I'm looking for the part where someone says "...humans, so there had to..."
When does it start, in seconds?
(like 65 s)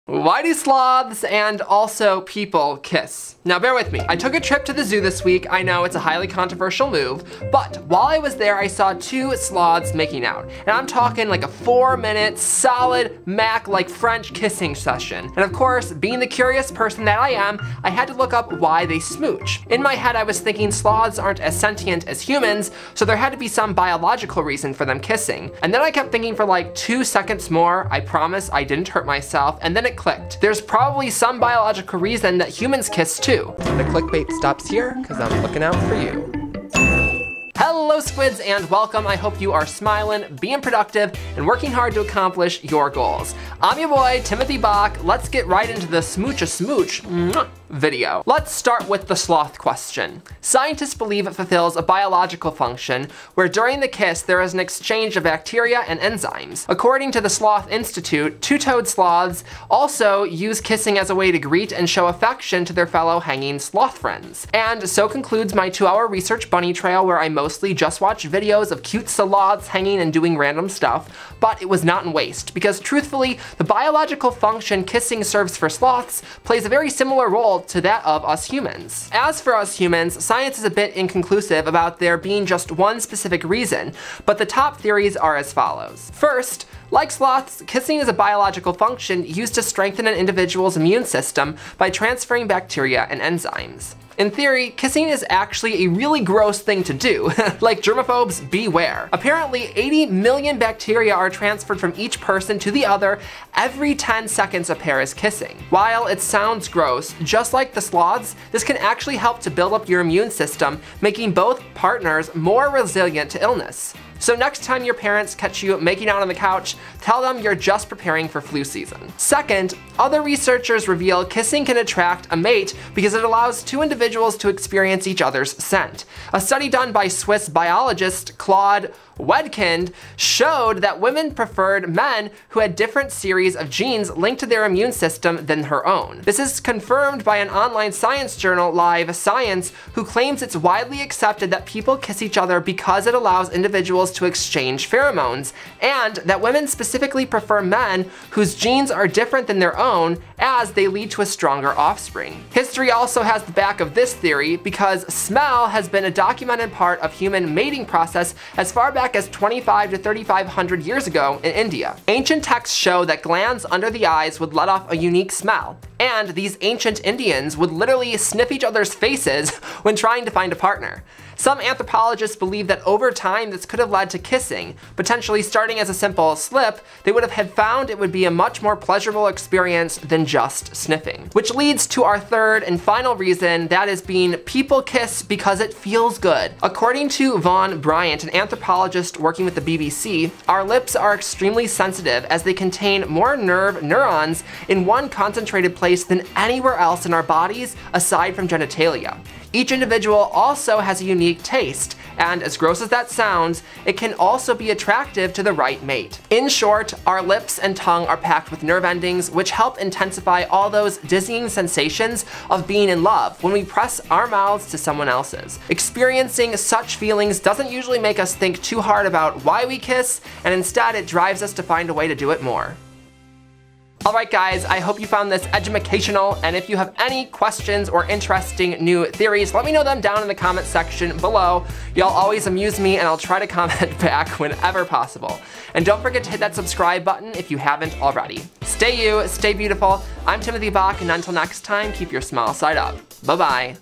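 22 s.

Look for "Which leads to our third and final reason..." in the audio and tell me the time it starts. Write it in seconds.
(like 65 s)
181 s.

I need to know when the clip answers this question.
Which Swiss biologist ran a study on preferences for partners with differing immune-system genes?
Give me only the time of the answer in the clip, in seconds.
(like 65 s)
128 s.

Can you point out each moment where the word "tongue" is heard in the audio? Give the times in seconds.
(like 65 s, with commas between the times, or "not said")
207 s.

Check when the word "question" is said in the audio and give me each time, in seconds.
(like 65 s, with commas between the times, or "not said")
49 s, 227 s.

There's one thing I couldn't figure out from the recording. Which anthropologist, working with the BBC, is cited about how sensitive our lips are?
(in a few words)
Vaughn Bryant.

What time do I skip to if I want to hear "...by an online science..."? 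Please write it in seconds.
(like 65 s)
137 s.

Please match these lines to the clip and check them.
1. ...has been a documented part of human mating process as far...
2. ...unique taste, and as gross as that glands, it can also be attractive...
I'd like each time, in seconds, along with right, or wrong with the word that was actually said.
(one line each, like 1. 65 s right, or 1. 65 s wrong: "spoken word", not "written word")
1. 155 s right
2. 201 s wrong: "sounds", not "glands".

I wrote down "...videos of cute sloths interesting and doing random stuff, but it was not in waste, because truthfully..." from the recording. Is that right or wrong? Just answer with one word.
wrong.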